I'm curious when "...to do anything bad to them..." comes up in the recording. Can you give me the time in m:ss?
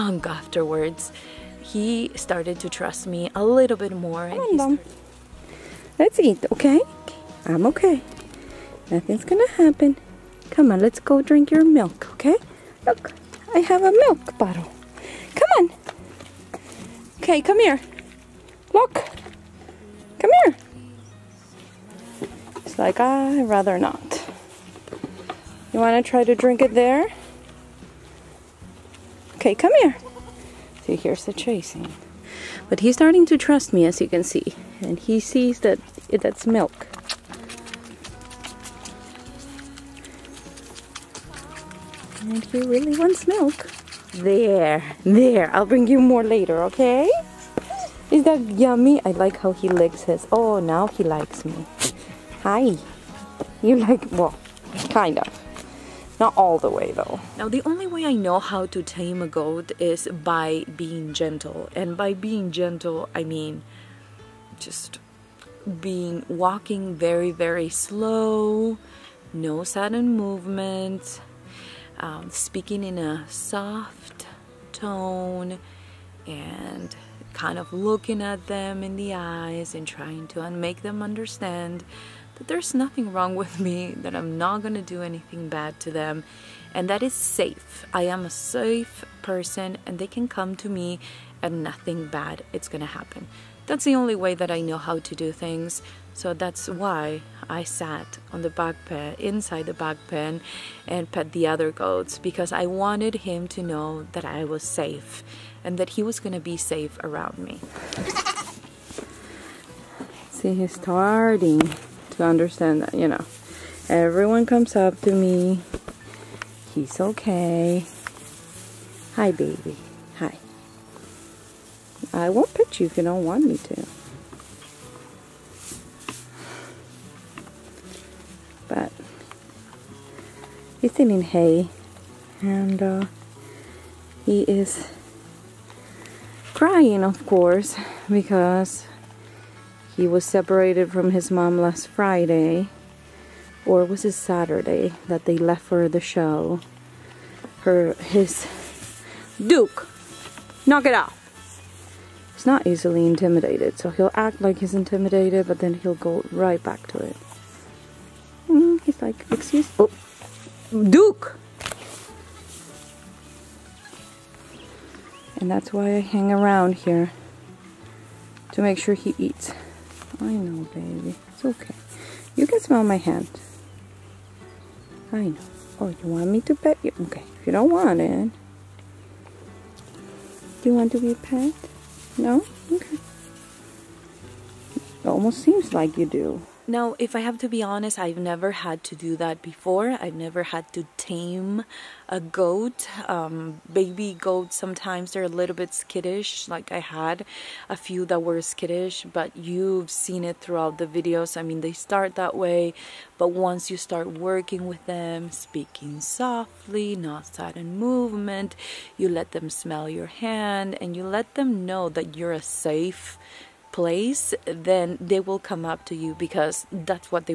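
1:24.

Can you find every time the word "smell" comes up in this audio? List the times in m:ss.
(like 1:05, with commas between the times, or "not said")
2:52, 3:29.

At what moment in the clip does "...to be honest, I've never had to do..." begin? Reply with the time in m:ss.
3:07.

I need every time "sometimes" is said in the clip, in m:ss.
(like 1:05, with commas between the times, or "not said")
3:14.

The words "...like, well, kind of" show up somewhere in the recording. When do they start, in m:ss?
0:53.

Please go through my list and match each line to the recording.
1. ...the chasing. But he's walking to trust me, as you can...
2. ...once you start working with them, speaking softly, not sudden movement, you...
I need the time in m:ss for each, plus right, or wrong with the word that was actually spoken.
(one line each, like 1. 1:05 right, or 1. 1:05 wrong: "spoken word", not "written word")
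1. 0:31 wrong: "starting", not "walking"
2. 3:23 right.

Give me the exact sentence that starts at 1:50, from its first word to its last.
See, he's starting to understand that, you know.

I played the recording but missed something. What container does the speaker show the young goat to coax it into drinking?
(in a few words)
milk bottle.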